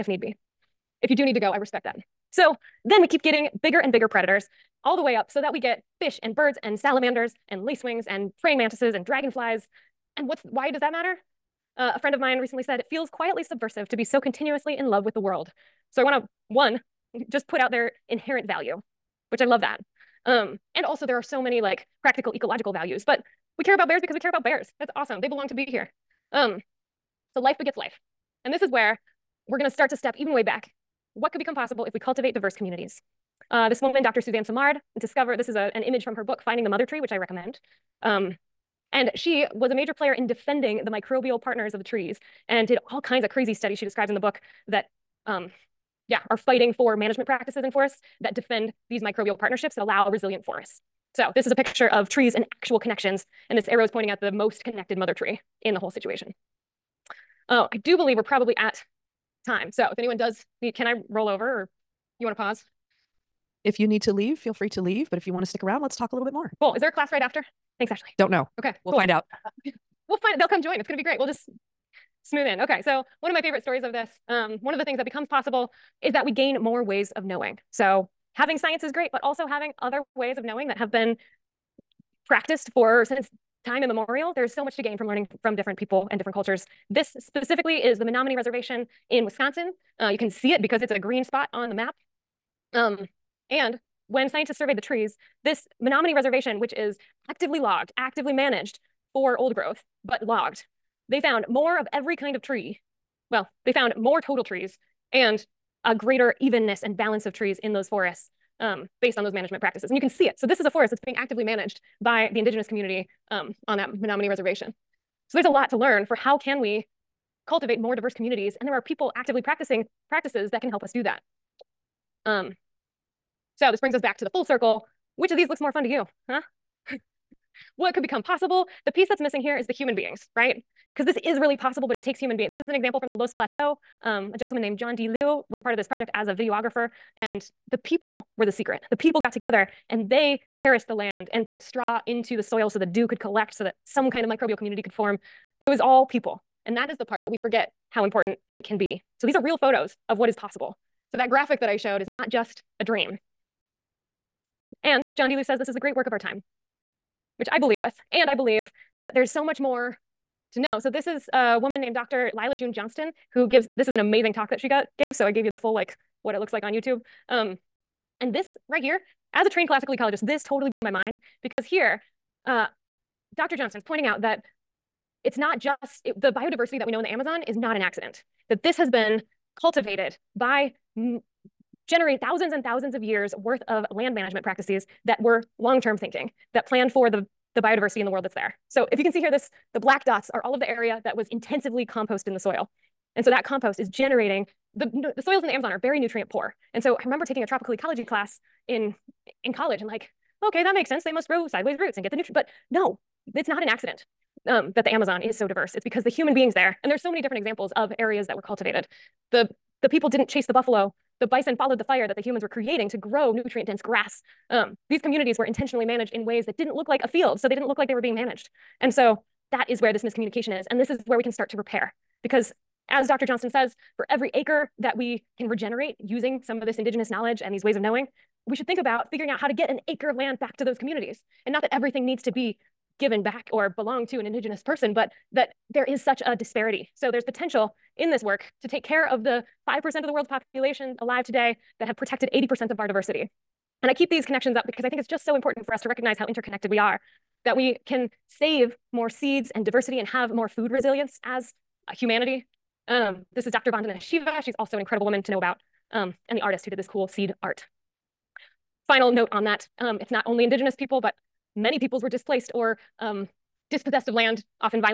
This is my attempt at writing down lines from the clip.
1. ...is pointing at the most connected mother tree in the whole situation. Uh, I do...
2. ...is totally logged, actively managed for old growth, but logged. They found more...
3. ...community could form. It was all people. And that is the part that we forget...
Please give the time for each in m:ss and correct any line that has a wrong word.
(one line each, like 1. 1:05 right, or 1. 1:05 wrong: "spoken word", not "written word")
1. 0:53 right
2. 1:36 wrong: "actively", not "totally"
3. 2:24 right.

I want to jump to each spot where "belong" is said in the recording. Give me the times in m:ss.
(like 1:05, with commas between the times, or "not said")
0:25, 3:53.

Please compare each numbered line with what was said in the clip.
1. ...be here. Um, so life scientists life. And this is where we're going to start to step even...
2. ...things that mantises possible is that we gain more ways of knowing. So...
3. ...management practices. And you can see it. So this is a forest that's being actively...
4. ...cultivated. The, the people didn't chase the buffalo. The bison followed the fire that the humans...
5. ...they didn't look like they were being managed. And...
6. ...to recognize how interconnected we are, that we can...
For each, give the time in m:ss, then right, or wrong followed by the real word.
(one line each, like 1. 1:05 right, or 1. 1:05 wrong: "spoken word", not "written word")
1. 0:25 wrong: "begets", not "scientists"
2. 1:14 wrong: "becomes", not "mantises"
3. 1:49 right
4. 3:28 right
5. 3:37 right
6. 4:05 right.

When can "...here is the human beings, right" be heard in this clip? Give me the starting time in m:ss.
2:09.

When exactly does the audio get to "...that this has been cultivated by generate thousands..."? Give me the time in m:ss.
2:58.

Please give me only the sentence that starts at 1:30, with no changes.
Uh, you can see it because it's a green spot on the map.